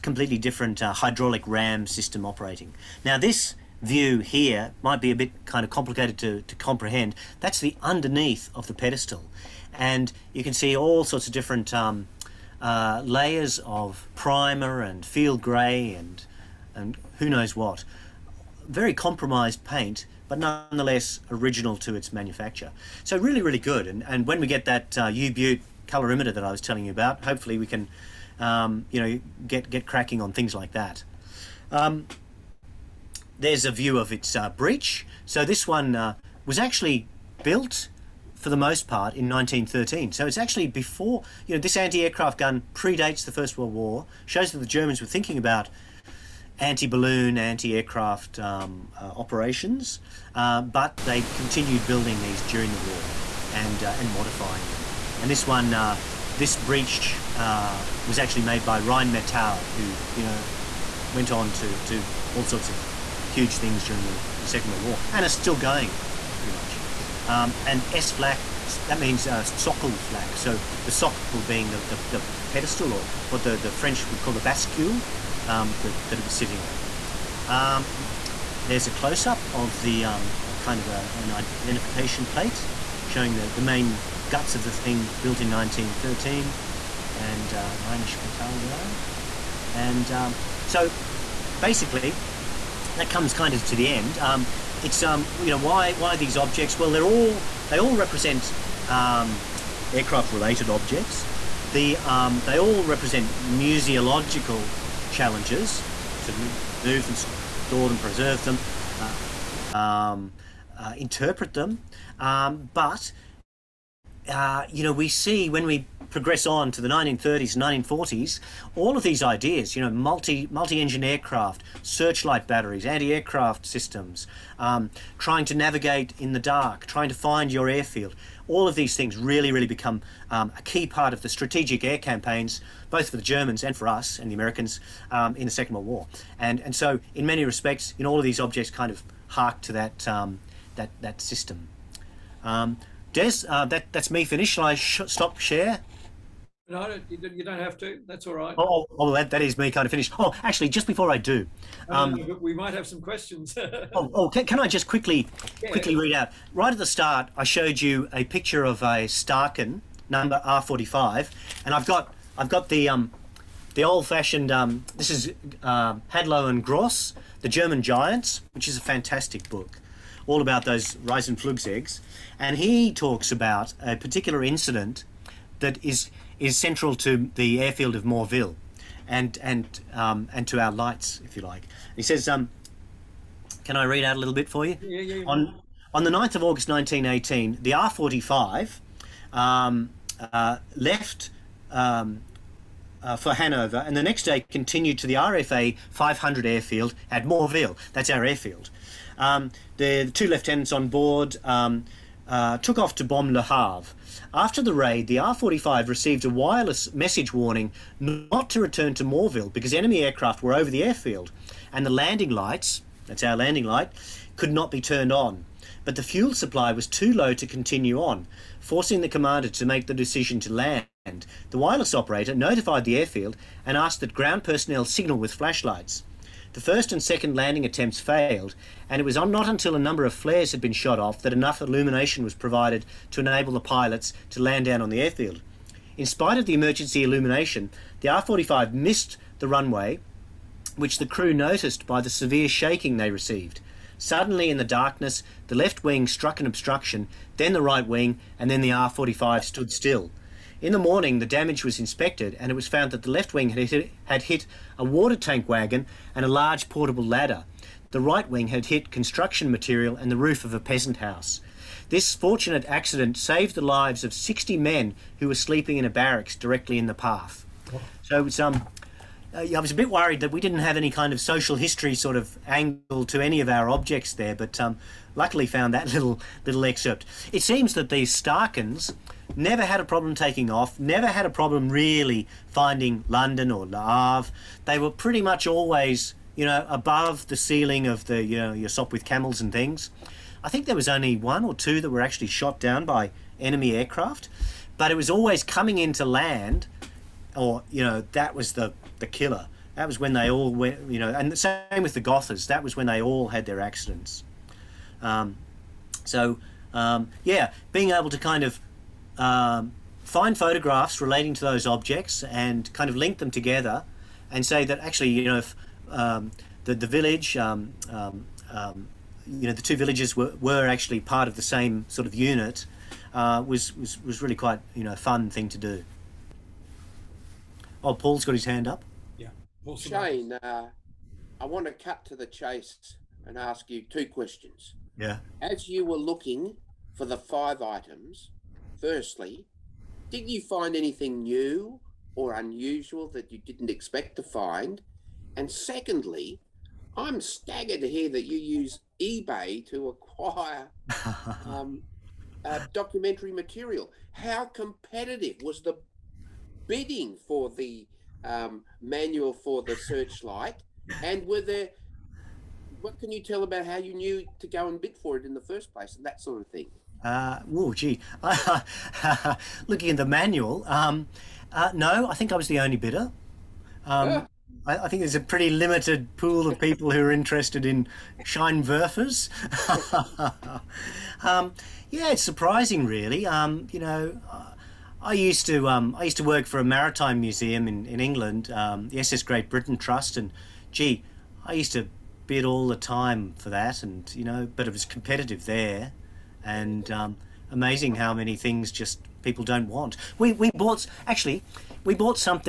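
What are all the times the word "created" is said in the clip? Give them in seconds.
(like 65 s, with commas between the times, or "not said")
not said.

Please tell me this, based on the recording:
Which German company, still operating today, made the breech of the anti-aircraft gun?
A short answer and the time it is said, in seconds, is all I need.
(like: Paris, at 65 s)
Rheinmetall, at 58 s.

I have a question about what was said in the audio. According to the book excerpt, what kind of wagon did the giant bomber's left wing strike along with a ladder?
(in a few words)
Water tank wagon.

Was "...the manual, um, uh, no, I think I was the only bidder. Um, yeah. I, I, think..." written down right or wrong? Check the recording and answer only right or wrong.
right.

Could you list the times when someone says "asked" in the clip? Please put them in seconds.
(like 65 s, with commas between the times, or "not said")
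223 s.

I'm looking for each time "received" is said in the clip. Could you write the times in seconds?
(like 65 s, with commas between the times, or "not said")
205 s, 243 s.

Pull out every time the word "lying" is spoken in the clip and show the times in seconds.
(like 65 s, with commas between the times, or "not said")
not said.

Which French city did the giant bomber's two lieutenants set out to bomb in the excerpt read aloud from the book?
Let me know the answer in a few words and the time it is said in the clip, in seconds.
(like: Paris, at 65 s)
Le Havre, at 203 s.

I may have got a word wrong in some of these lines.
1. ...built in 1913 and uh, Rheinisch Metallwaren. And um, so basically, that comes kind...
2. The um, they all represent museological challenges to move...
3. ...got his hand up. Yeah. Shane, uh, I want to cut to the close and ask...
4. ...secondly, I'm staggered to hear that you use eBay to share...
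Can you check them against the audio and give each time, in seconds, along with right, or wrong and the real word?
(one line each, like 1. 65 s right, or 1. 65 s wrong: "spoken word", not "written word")
1. 85 s right
2. 101 s right
3. 328 s wrong: "chase", not "close"
4. 345 s wrong: "acquire", not "share".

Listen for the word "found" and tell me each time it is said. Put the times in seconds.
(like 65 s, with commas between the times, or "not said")
252 s, 275 s.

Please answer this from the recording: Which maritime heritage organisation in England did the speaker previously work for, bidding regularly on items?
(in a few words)
SS Great Britain Trust.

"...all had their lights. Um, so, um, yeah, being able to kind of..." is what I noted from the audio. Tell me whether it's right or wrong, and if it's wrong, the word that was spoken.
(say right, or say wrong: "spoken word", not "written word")
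wrong: "accidents", not "lights".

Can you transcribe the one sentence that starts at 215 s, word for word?
But the fuel supply was too low to continue on, forcing the commander to make the decision to land.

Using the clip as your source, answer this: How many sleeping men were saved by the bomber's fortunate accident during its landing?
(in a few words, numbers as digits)
60.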